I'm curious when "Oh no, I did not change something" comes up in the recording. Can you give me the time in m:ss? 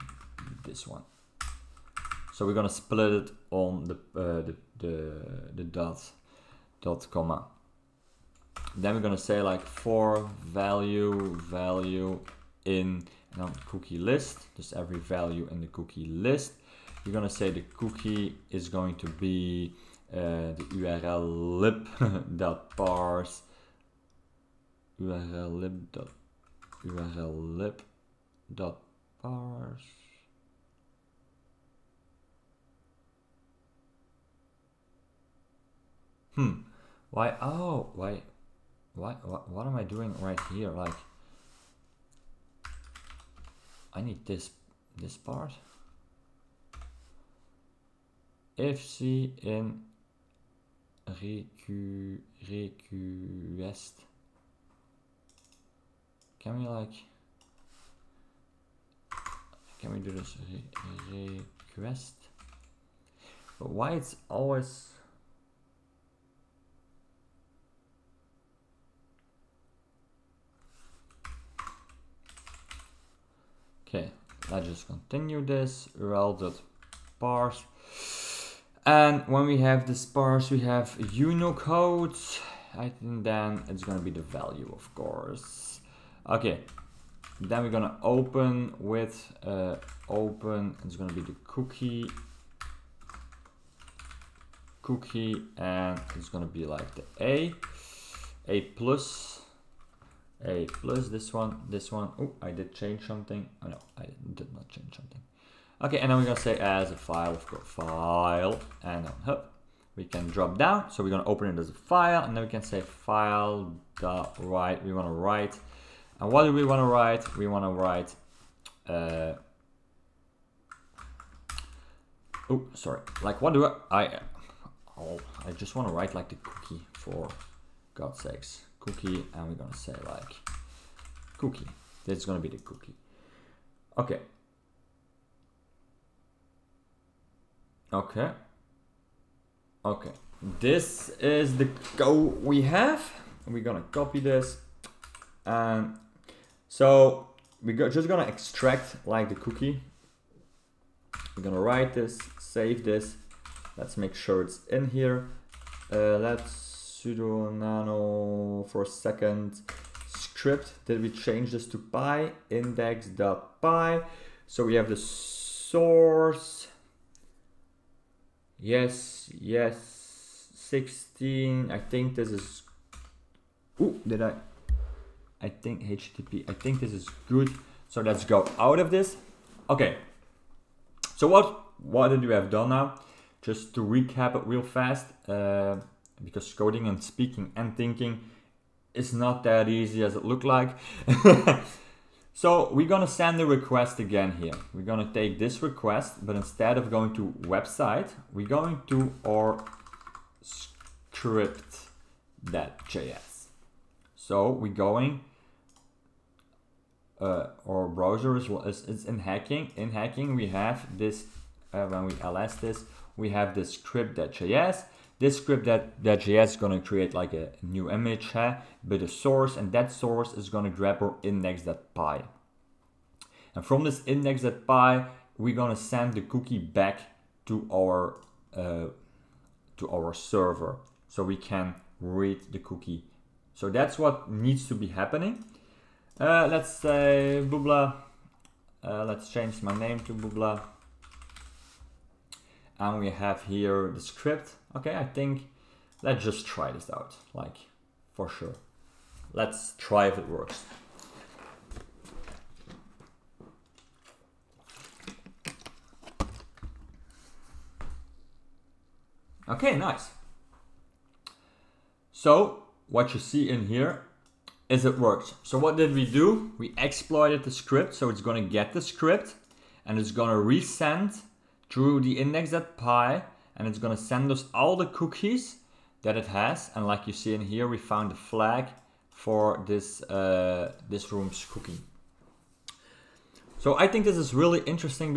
1:43.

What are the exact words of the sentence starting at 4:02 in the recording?
And we have here the script okay, I think let's just try this out, like for sure.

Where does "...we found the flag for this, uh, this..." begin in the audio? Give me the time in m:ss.
4:37.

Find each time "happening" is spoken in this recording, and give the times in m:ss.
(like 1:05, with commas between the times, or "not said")
3:54.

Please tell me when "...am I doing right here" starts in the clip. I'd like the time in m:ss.
0:39.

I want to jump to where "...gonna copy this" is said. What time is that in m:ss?
2:23.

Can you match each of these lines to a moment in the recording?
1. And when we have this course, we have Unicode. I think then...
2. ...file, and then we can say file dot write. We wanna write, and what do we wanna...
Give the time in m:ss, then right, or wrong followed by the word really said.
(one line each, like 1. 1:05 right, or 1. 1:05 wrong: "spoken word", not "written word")
1. 1:18 wrong: "parse", not "course"
2. 1:51 right.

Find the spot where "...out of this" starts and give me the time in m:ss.
2:58.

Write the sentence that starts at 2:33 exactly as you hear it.
Let's make sure it's in here.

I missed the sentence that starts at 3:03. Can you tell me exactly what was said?
Just to recap it real fast.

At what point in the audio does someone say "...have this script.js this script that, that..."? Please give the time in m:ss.
3:33.